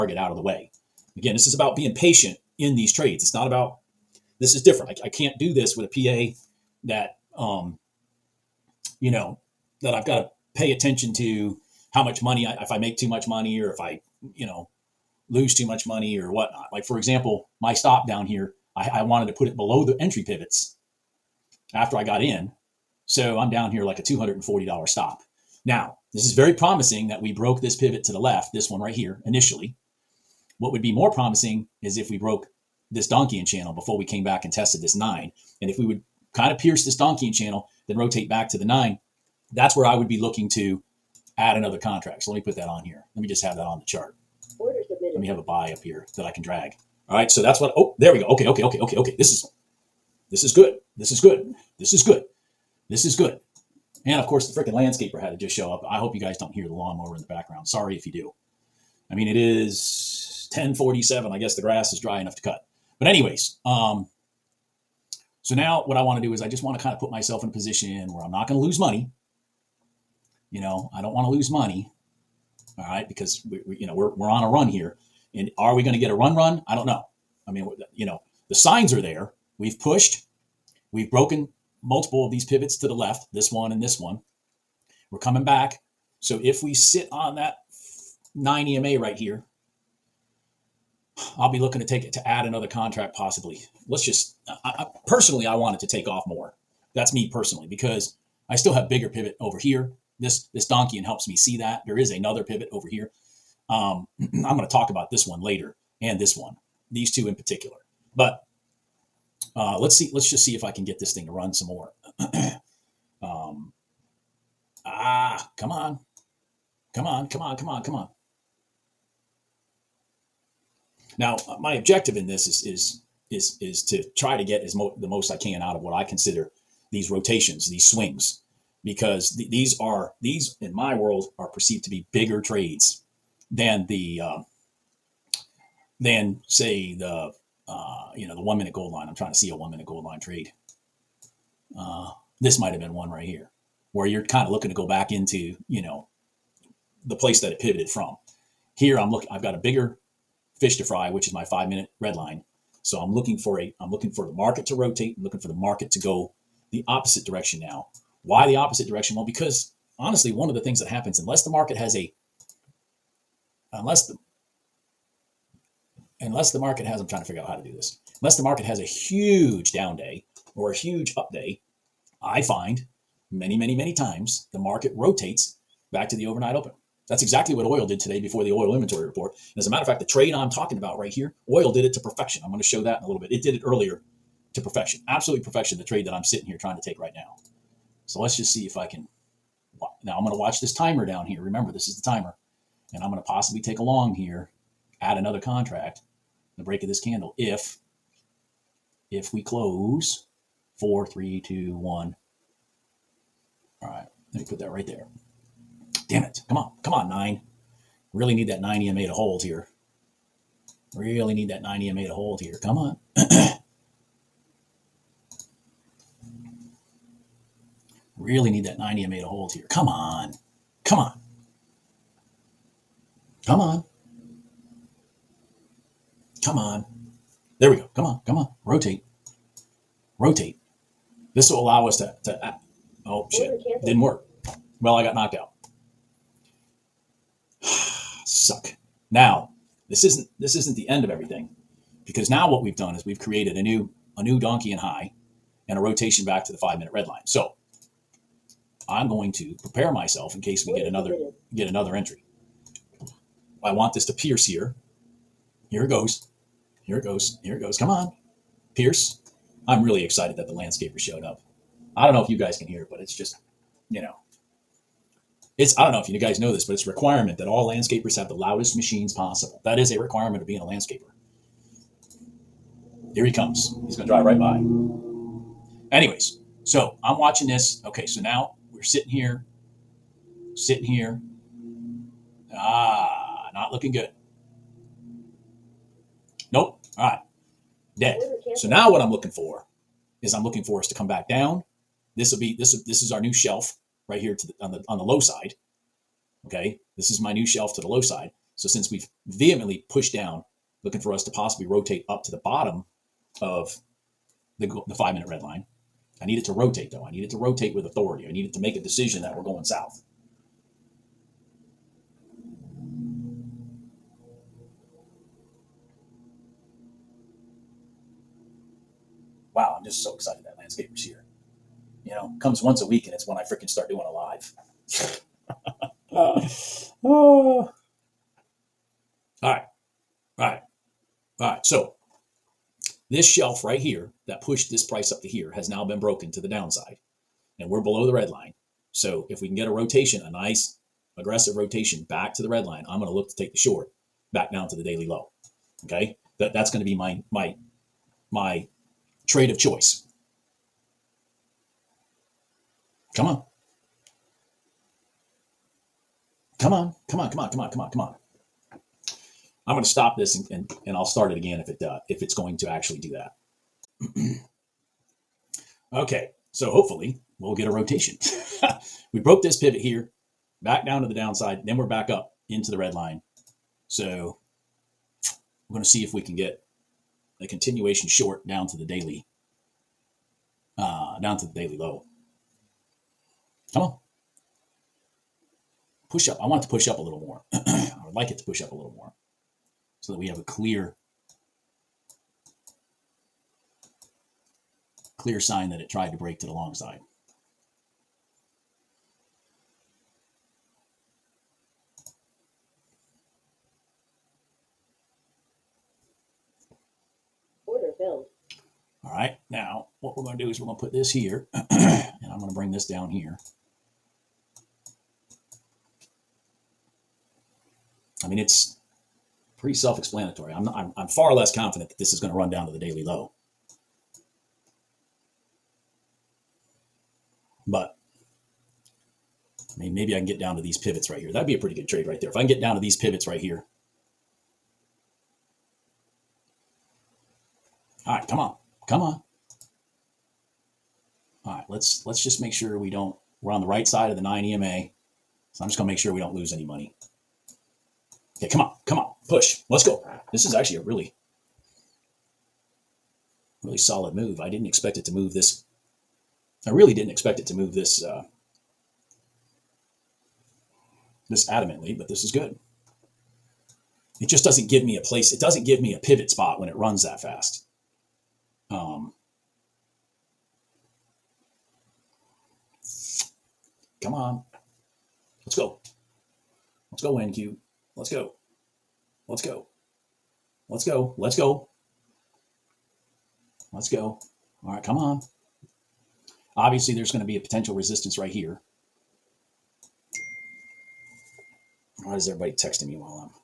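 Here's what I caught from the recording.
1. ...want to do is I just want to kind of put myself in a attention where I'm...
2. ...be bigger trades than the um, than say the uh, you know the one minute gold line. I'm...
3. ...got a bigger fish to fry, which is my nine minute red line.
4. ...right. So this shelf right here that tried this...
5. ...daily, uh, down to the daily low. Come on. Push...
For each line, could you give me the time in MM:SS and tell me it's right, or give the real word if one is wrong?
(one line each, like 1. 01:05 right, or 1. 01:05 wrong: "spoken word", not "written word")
1. 01:06 wrong: "position", not "attention"
2. 02:11 right
3. 02:29 wrong: "five", not "nine"
4. 05:31 wrong: "pushed", not "tried"
5. 06:18 right.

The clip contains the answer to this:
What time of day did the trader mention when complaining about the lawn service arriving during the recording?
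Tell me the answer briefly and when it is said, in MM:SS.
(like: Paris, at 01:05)
10:47, at 01:00.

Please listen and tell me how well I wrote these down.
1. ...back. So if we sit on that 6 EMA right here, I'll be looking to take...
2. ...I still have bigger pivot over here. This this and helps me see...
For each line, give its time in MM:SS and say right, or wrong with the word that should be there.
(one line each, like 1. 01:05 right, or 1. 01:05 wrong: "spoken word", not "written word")
1. 01:25 wrong: "9", not "6"
2. 01:38 right.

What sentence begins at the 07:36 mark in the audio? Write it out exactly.
I really didn't expect it to move this.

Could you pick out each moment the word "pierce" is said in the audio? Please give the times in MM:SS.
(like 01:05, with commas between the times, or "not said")
00:36, 04:14, 04:18.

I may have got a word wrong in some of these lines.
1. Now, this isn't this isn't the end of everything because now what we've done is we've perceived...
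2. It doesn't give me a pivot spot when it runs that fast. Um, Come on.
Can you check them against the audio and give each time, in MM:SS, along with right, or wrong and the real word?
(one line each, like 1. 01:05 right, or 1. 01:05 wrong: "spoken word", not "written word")
1. 03:59 wrong: "created", not "perceived"
2. 07:45 right.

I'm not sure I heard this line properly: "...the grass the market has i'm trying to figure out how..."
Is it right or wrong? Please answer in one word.
wrong.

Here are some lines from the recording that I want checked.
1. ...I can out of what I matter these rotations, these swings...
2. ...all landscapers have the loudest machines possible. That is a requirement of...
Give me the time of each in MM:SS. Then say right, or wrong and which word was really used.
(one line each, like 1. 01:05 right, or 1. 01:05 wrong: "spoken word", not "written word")
1. 02:05 wrong: "consider", not "matter"
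2. 04:27 right.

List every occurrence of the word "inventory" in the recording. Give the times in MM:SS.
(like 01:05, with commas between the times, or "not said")
02:58.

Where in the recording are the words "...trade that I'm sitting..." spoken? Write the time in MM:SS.
03:05.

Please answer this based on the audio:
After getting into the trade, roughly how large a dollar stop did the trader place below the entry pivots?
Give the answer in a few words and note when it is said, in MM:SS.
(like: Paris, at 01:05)
$240, at 00:24.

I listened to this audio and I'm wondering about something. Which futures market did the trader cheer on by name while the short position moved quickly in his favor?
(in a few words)
NQ.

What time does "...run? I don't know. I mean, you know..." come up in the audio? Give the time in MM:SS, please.
01:16.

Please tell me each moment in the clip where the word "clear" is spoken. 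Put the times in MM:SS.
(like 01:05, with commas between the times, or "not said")
06:30, 06:35.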